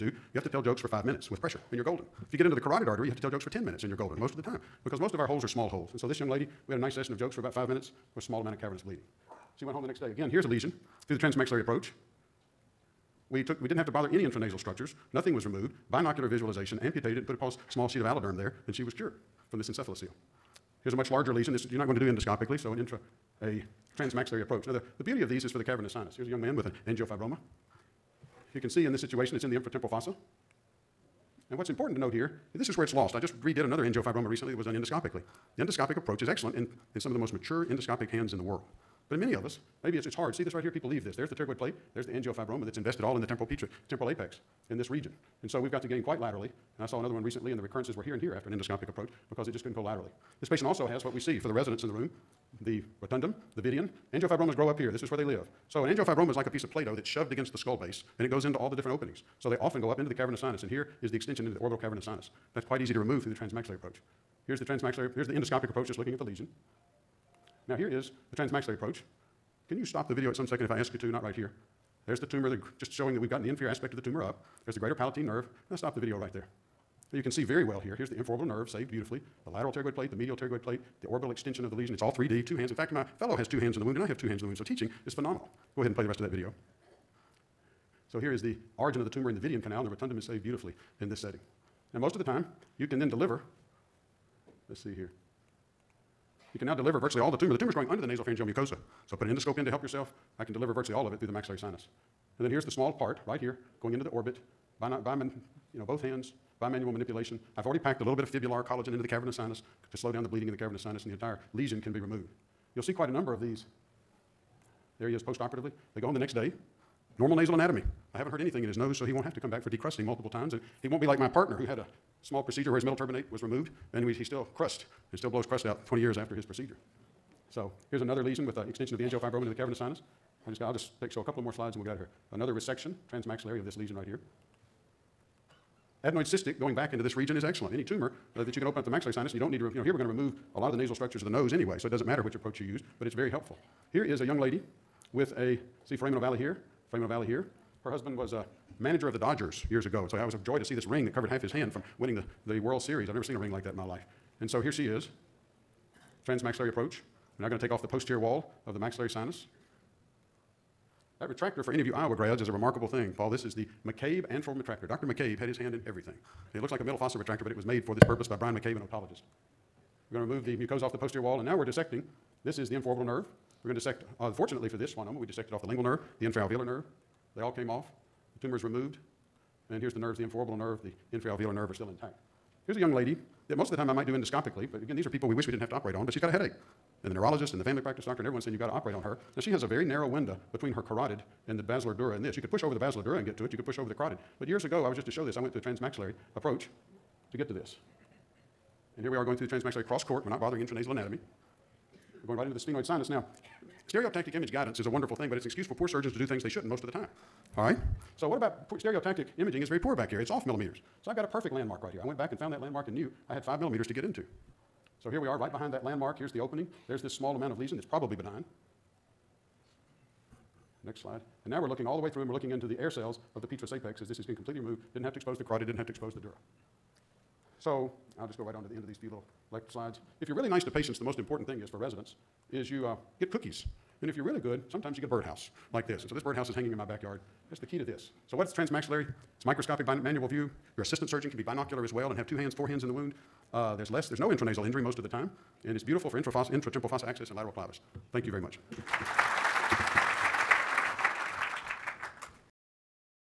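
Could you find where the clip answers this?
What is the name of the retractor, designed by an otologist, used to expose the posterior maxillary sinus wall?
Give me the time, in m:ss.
2:43.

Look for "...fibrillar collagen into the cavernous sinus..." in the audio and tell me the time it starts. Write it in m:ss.
1:48.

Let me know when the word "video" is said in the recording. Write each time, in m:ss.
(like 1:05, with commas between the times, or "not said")
1:10, 1:15, 1:26.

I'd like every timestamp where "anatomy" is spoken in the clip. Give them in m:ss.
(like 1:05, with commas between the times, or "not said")
1:57, 3:20.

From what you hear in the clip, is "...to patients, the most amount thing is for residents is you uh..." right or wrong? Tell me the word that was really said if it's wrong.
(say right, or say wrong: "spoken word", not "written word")
wrong: "important", not "amount".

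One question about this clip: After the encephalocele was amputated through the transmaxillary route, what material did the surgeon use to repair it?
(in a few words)
AlloDerm.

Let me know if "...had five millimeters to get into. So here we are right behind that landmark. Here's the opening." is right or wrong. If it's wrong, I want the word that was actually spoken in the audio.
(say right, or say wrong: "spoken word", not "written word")
right.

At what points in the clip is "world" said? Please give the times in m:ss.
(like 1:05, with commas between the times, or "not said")
0:38, 2:32.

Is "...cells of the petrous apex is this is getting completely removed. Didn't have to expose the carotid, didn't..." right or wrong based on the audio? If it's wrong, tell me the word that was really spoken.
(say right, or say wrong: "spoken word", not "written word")
right.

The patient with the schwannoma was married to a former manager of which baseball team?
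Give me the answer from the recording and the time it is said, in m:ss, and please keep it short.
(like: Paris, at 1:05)
Dodgers, at 2:29.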